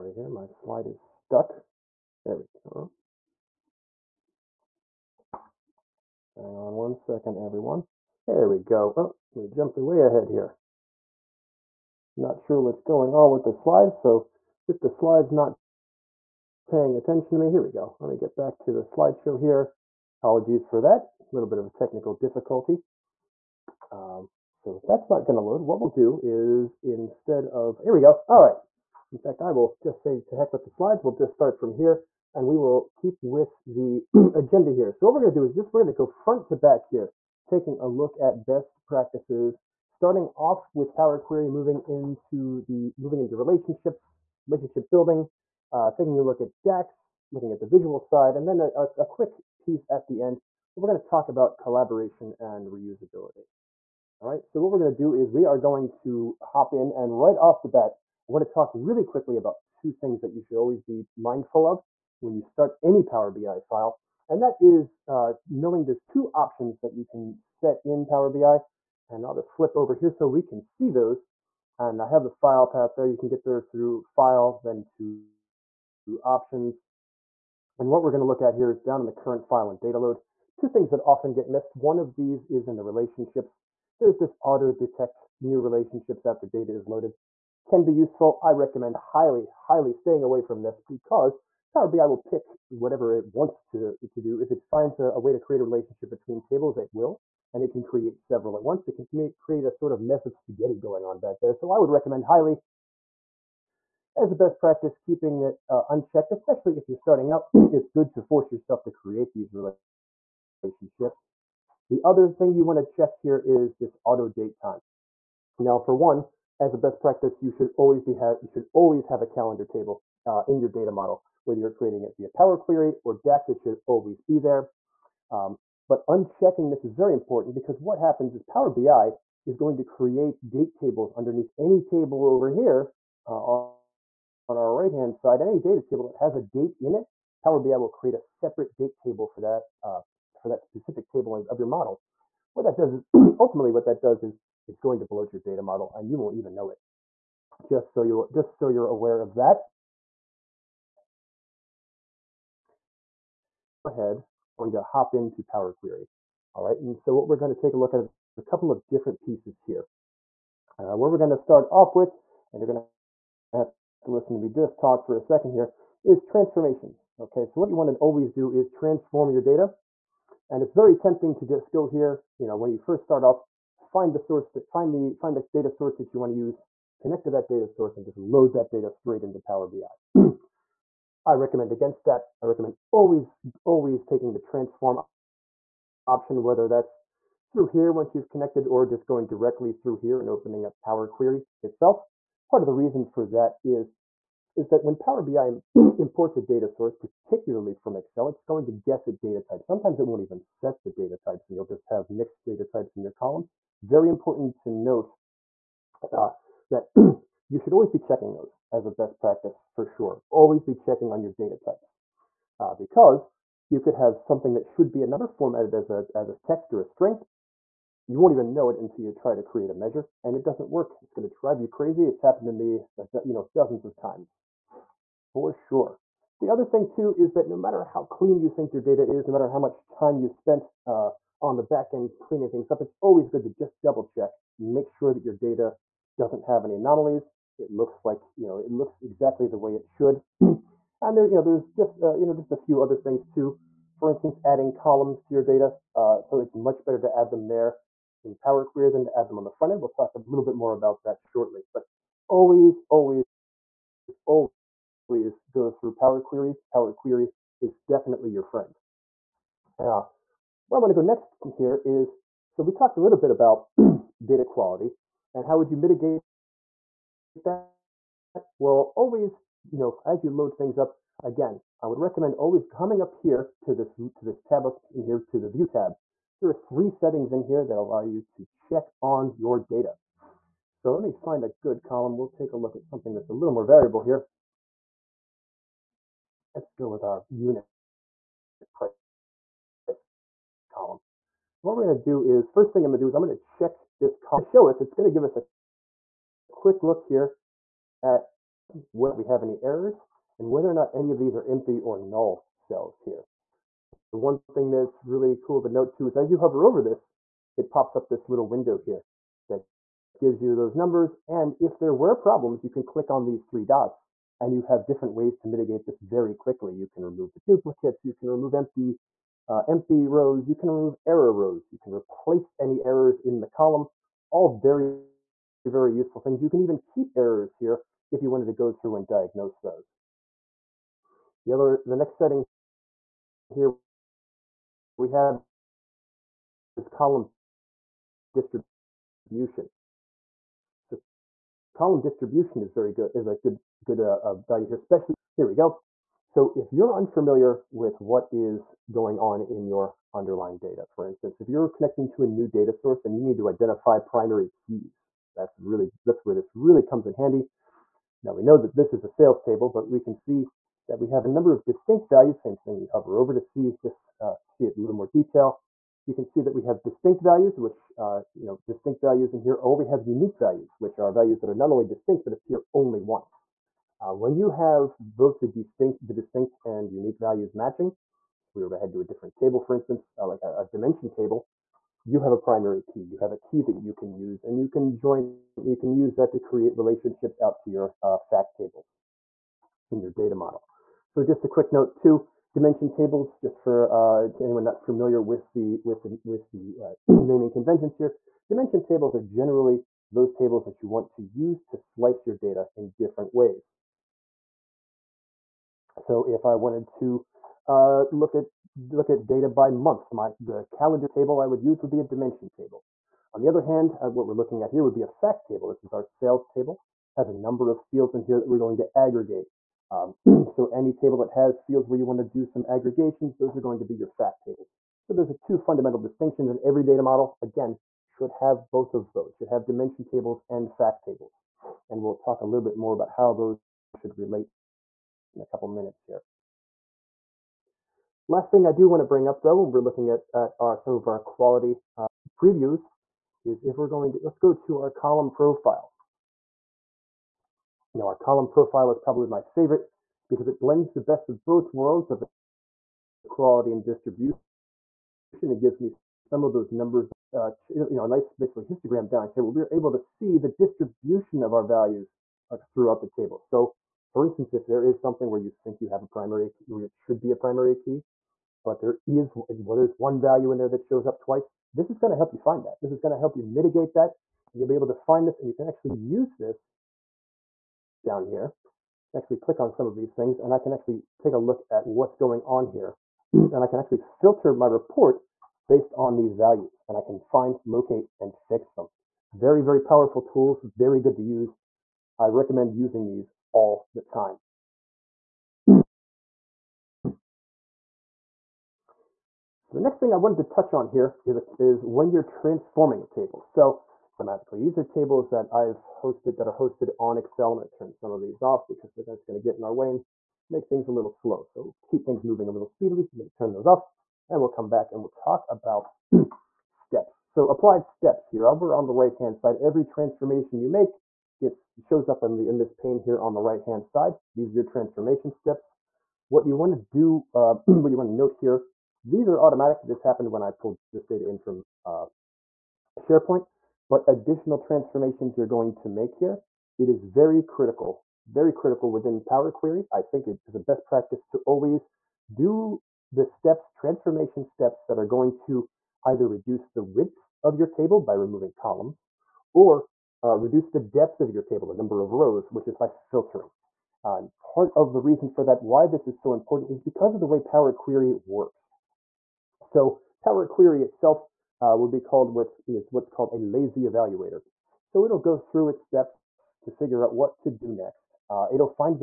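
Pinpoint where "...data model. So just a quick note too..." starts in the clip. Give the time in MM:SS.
06:30.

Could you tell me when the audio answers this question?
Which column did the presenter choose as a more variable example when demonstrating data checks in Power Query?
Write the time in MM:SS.
04:47.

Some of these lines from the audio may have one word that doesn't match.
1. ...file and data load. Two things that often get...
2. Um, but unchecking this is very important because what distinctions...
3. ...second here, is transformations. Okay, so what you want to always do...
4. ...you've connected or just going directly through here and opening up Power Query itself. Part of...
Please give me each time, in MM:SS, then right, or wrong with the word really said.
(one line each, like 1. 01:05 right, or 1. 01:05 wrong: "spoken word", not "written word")
1. 01:19 right
2. 02:05 wrong: "happens", not "distinctions"
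3. 02:45 right
4. 03:08 right.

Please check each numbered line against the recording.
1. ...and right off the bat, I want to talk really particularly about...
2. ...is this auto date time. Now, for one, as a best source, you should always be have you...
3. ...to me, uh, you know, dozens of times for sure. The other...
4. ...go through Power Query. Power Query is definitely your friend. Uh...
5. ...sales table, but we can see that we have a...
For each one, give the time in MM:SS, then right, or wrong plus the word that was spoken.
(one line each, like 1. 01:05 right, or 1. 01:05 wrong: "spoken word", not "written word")
1. 00:56 wrong: "quickly", not "particularly"
2. 01:53 wrong: "practice", not "source"
3. 03:42 right
4. 04:15 right
5. 05:59 right.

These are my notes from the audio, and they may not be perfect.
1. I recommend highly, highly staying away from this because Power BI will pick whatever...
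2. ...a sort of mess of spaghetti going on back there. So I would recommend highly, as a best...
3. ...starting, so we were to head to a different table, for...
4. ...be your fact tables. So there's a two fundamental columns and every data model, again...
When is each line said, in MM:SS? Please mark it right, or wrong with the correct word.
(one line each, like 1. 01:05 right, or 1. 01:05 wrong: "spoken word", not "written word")
1. 01:28 right
2. 01:39 right
3. 06:17 wrong: "matching", not "starting"
4. 07:03 wrong: "distinctions", not "columns".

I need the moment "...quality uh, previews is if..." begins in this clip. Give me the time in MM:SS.
07:21.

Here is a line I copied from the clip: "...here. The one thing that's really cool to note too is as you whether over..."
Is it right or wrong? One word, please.
wrong.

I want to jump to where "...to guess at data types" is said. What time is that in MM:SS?
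03:18.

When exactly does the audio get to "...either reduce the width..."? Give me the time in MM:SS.
09:06.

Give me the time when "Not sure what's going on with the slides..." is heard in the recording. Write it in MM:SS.
00:12.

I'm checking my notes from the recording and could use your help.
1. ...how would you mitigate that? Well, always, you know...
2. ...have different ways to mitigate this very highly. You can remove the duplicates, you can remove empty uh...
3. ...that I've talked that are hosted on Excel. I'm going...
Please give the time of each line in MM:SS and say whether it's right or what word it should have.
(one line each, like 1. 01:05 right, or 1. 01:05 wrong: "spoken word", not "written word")
1. 04:25 right
2. 05:14 wrong: "quickly", not "highly"
3. 08:25 wrong: "hosted", not "talked".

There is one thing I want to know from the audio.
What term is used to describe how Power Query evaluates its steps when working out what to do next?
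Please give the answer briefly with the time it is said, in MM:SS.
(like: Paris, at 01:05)
Lazy evaluator, at 09:23.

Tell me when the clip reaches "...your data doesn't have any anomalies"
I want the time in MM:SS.
03:55.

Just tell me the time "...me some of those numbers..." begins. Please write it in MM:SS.
07:35.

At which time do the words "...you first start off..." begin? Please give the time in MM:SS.
02:52.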